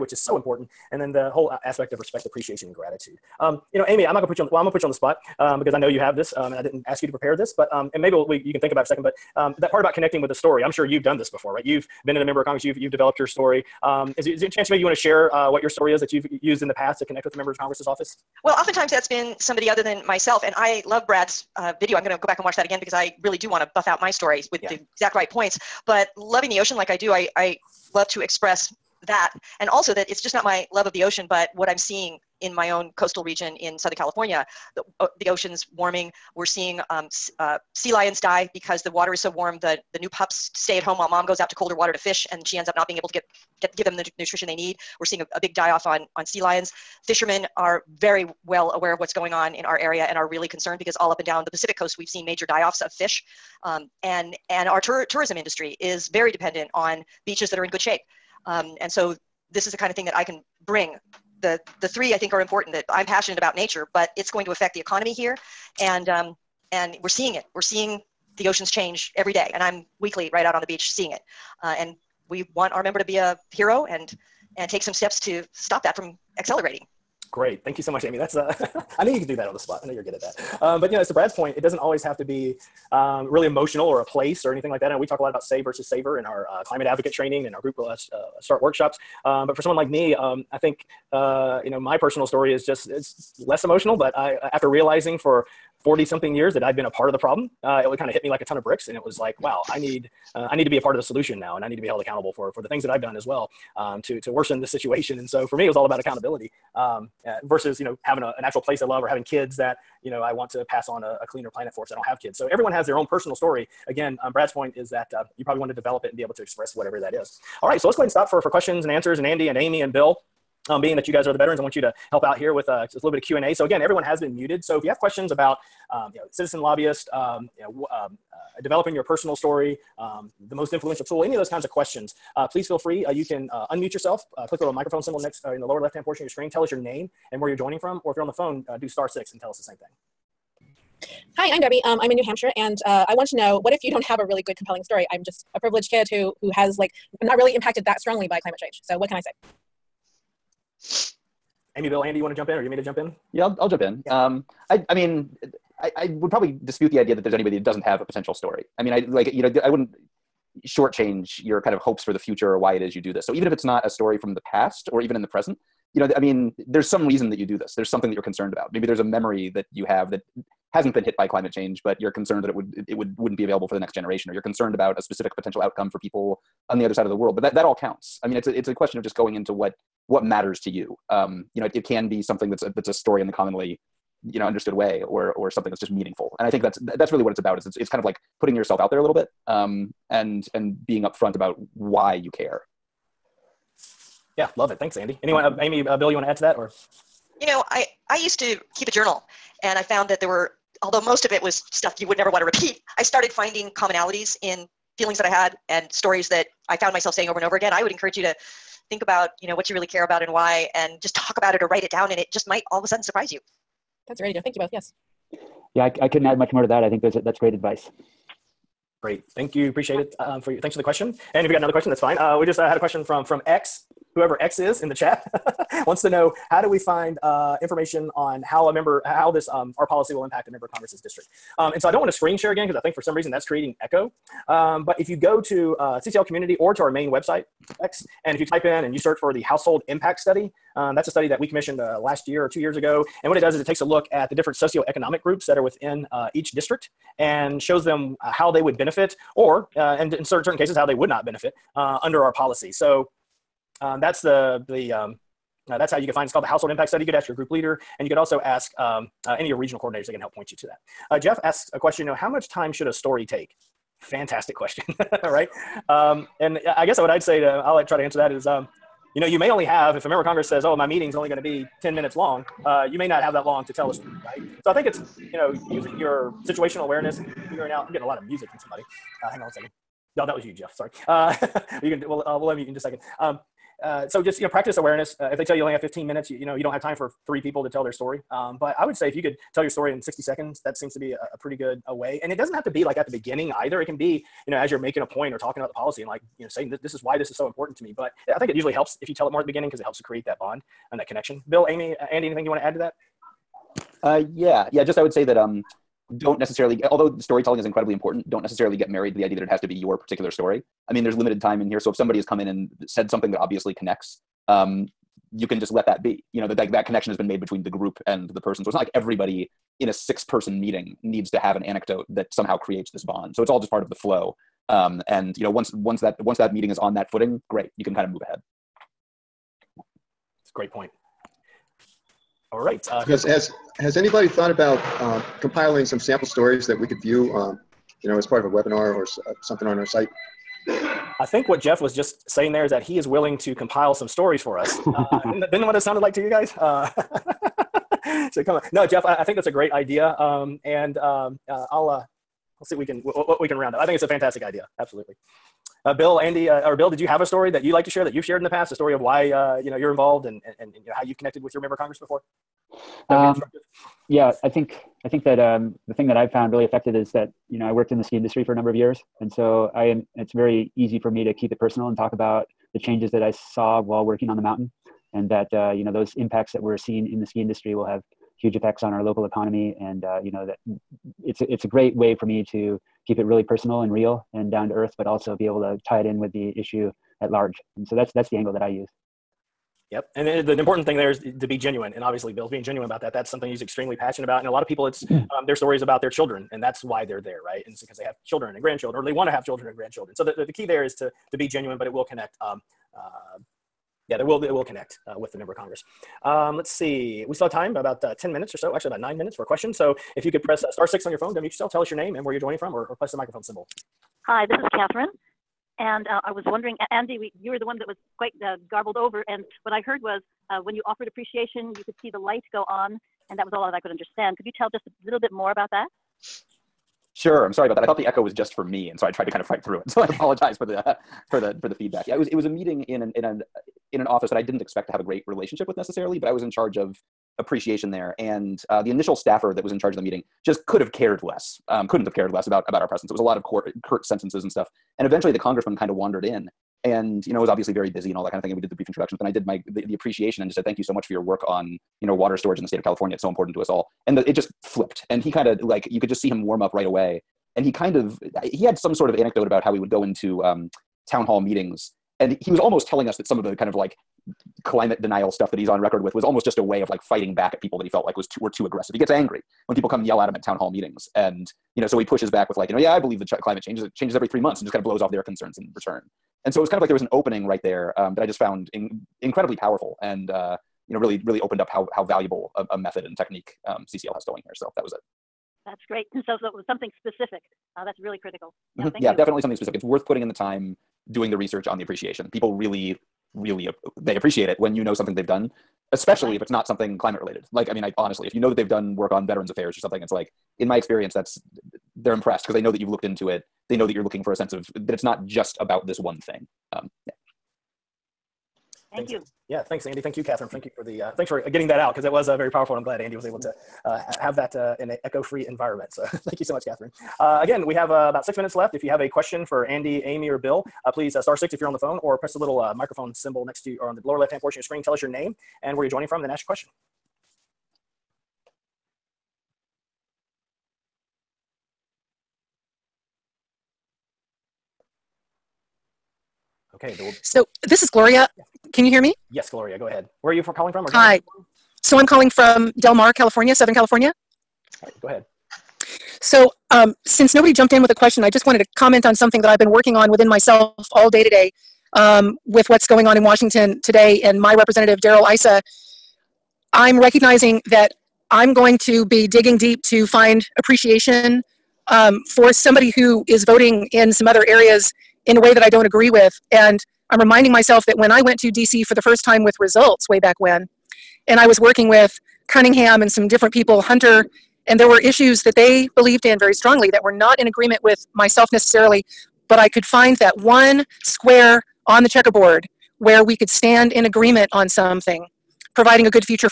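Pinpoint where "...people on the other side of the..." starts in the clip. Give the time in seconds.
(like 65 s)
175 s.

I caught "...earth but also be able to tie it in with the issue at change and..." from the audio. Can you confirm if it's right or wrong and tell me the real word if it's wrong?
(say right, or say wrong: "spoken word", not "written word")
wrong: "large", not "change".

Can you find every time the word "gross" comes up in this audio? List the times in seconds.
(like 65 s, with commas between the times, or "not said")
not said.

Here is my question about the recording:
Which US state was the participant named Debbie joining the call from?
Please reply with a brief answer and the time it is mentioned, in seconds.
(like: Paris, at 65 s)
New Hampshire, at 142 s.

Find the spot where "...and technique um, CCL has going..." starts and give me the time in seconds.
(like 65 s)
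483 s.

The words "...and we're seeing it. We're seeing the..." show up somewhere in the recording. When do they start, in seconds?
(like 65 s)
66 s.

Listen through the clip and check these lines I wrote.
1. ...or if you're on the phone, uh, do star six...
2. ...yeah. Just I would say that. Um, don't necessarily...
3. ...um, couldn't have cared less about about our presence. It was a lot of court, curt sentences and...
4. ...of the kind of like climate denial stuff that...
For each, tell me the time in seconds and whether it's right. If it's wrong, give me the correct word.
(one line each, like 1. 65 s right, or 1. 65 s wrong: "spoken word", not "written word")
1. 138 s right
2. 304 s right
3. 441 s right
4. 463 s right.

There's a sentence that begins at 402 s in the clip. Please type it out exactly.
Um, uh, yeah, there will, it will connect uh, with the member of Congress.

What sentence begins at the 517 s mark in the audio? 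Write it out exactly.
Uh, again, we have uh, about six minutes left.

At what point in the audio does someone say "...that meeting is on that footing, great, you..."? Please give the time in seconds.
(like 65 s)
326 s.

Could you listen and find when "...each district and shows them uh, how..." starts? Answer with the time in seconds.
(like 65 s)
246 s.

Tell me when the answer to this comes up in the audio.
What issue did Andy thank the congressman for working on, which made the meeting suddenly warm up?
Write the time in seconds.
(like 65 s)
452 s.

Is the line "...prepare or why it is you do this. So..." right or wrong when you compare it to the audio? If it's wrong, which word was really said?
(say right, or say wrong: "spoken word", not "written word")
wrong: "future", not "prepare".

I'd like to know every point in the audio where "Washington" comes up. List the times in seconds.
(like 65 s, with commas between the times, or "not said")
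553 s.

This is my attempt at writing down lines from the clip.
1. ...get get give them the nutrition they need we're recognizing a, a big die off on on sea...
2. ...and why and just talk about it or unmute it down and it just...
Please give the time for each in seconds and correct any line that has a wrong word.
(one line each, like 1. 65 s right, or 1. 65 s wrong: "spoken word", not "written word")
1. 43 s wrong: "seeing", not "recognizing"
2. 210 s wrong: "write", not "unmute".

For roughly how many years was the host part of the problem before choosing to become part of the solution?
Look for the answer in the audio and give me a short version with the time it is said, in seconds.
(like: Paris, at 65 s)
40 something, at 95 s.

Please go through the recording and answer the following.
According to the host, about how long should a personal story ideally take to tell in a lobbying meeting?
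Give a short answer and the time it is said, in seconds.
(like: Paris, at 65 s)
60 seconds, at 290 s.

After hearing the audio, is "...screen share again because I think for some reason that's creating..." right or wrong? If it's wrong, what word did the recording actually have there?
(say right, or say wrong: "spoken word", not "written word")
right.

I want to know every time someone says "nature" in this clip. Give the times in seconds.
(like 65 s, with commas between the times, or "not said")
63 s.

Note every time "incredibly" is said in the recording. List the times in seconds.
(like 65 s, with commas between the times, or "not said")
307 s, 479 s.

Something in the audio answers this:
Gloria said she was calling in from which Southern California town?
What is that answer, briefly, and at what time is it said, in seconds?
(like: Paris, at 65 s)
Del Mar, at 542 s.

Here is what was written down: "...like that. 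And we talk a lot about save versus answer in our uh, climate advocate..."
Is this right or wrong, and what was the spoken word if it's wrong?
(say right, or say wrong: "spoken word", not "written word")
wrong: "saver", not "answer".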